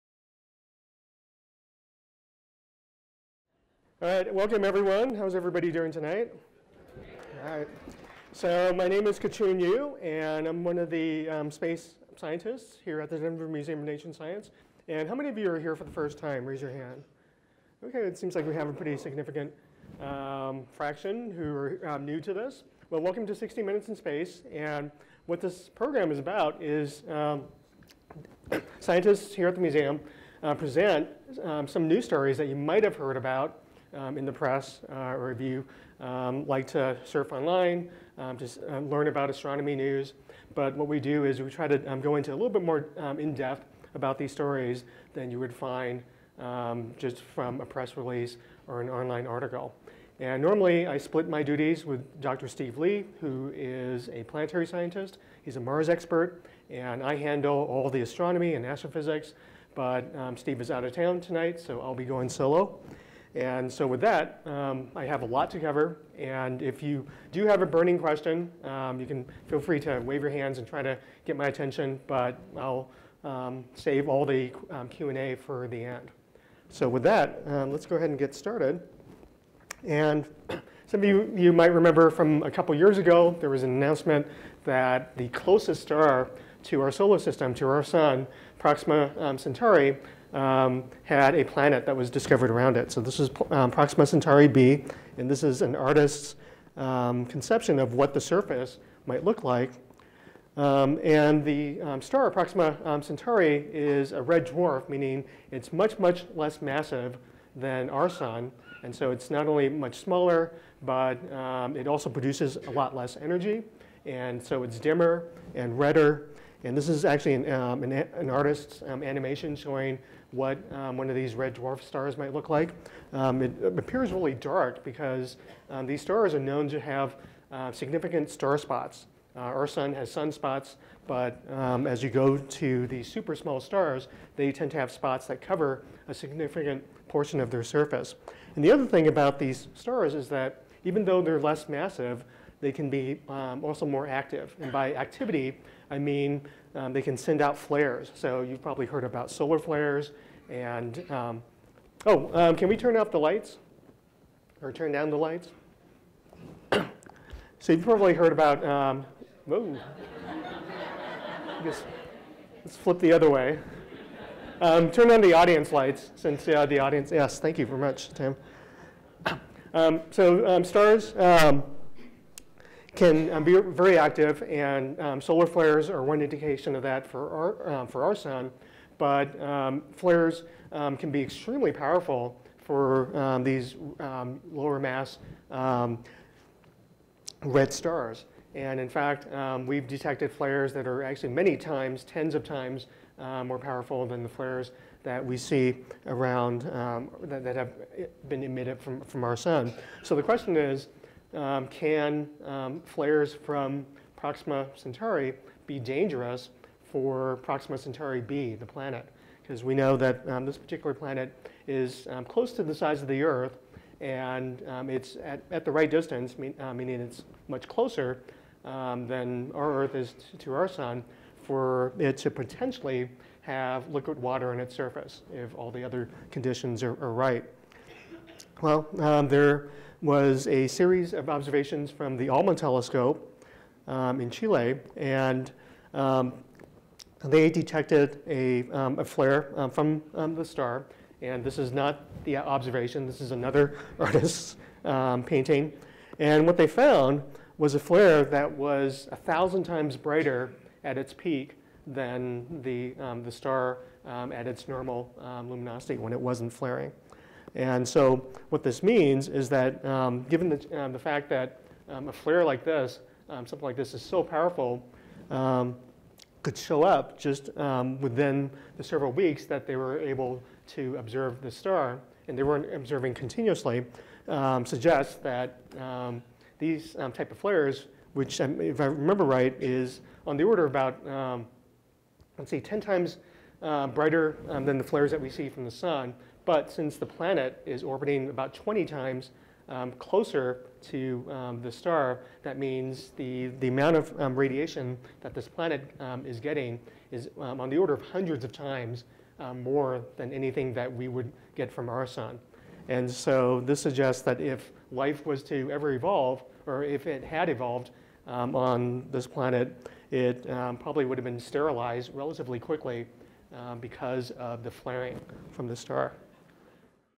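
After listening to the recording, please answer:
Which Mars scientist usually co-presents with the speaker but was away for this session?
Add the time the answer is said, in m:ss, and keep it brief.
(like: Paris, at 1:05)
Steve Lee, at 0:52.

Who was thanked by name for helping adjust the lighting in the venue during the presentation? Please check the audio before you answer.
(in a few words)
Tim.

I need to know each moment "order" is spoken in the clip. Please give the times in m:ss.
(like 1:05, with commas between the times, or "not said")
4:40, 4:57.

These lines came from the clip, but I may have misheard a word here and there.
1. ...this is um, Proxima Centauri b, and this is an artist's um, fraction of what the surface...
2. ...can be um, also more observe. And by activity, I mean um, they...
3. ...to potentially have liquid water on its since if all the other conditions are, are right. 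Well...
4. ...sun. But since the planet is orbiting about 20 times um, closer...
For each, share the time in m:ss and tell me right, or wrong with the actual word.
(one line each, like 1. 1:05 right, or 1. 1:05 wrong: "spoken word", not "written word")
1. 1:33 wrong: "conception", not "fraction"
2. 2:22 wrong: "active", not "observe"
3. 3:42 wrong: "surface", not "since"
4. 4:45 right.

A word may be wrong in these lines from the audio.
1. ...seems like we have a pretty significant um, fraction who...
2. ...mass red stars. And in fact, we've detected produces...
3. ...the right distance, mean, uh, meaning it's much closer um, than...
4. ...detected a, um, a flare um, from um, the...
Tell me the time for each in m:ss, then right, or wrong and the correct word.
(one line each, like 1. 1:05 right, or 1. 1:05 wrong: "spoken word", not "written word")
1. 0:18 right
2. 3:04 wrong: "flares", not "produces"
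3. 3:35 right
4. 3:57 right.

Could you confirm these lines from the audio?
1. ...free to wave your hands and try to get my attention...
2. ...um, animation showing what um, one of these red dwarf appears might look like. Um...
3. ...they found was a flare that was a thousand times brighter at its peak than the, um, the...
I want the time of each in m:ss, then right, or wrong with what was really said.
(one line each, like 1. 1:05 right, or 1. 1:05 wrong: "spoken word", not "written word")
1. 1:09 right
2. 1:58 wrong: "stars", not "appears"
3. 4:06 right.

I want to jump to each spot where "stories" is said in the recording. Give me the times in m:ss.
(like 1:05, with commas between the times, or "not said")
0:32, 0:44.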